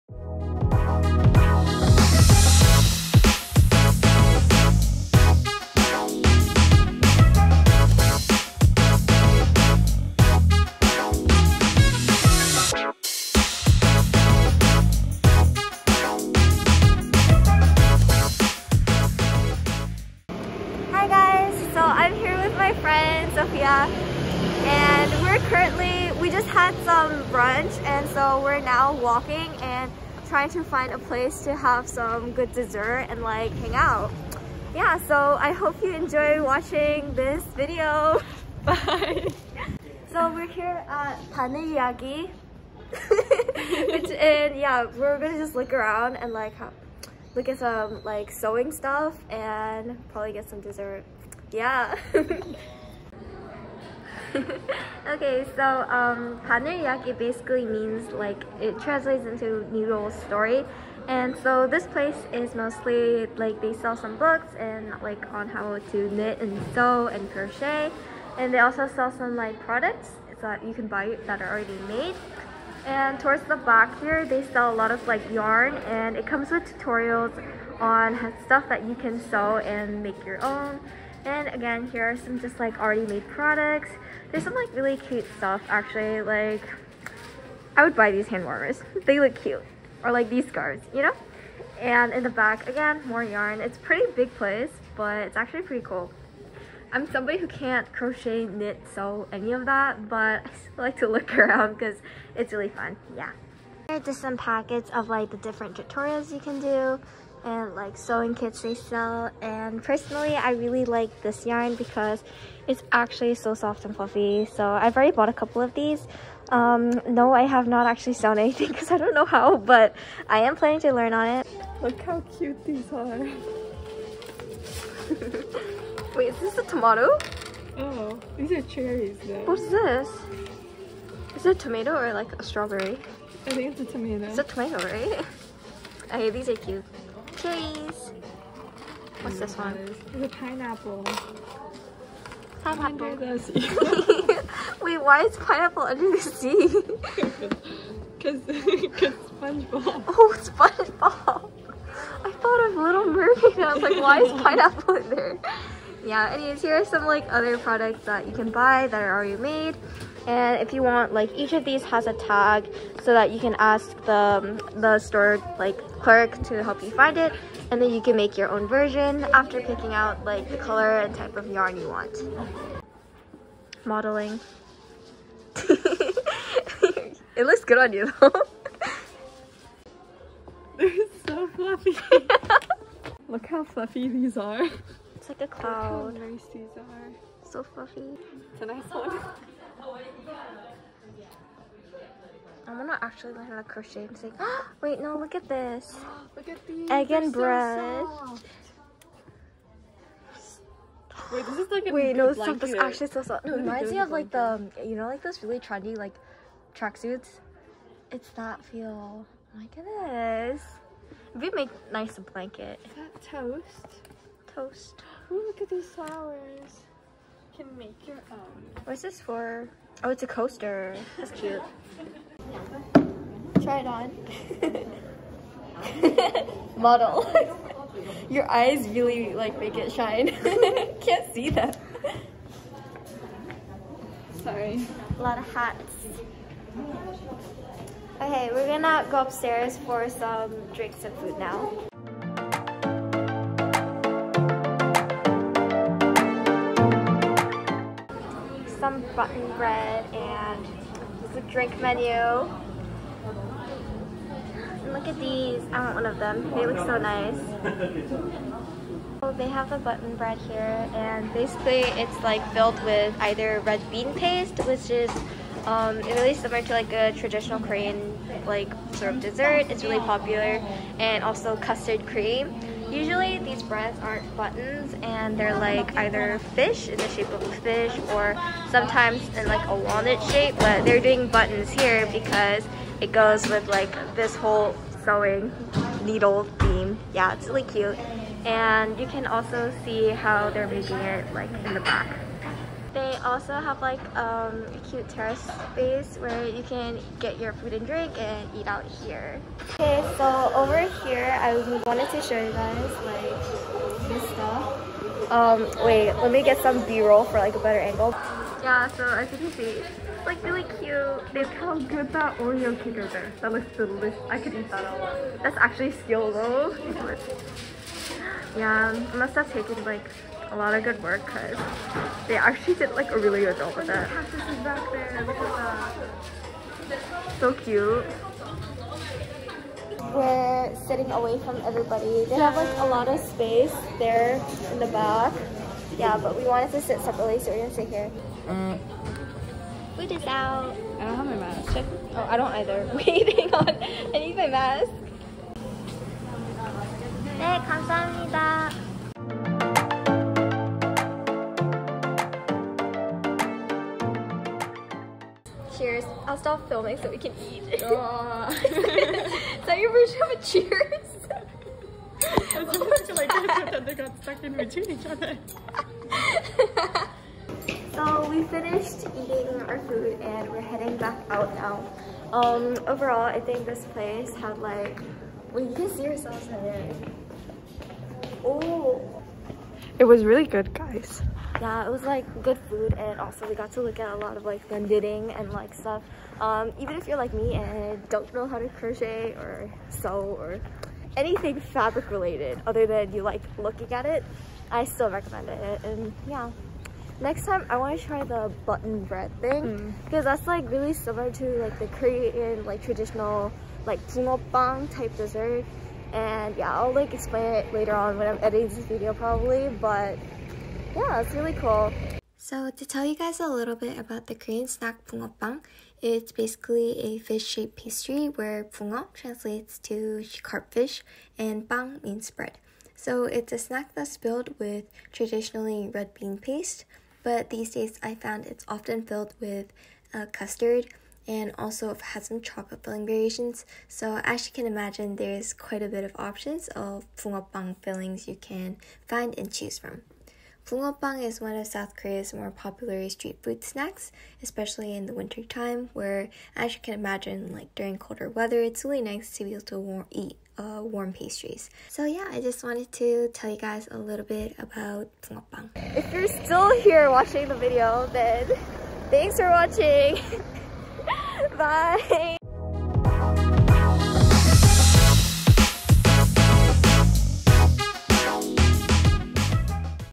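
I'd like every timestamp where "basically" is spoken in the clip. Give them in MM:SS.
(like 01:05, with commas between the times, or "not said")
00:57, 04:21, 06:56.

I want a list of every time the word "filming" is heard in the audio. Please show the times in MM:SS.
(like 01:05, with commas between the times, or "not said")
05:56.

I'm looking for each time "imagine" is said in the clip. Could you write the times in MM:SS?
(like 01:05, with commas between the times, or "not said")
07:14, 07:26.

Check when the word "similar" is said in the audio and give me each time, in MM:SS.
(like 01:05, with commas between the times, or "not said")
04:26, 06:40.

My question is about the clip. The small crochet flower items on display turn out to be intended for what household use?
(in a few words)
coaster.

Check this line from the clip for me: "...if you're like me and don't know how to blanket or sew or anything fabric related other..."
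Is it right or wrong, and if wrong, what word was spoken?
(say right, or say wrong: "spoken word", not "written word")
wrong: "crochet", not "blanket".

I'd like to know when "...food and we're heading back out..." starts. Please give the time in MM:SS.
06:09.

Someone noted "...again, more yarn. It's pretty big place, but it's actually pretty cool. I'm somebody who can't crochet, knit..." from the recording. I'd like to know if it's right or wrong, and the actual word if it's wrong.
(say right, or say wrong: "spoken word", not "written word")
right.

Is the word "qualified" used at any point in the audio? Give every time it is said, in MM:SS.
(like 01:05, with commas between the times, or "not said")
not said.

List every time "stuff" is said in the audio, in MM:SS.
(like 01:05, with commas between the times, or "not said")
00:48, 01:18, 01:25, 03:22, 05:04, 06:25.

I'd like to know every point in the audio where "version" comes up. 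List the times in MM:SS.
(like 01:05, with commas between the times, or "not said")
02:48, 05:59.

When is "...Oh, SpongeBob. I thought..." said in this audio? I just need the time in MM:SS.
02:30.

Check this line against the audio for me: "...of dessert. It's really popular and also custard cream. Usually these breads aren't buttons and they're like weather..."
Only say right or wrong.
wrong.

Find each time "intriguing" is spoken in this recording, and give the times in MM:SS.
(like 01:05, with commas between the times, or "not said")
not said.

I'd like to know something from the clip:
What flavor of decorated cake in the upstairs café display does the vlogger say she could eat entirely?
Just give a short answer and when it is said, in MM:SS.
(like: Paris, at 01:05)
Oreo, at 05:12.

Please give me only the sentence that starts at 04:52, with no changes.
They also have like um, a cute terrace space where you can get your food and drink and eat out here.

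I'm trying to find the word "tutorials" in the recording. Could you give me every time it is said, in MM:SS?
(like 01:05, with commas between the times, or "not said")
01:16, 01:45.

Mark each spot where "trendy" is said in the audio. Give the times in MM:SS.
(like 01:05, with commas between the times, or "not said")
03:25.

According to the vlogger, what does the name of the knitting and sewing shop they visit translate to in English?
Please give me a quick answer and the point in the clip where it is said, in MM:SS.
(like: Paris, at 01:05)
noodle story, at 00:59.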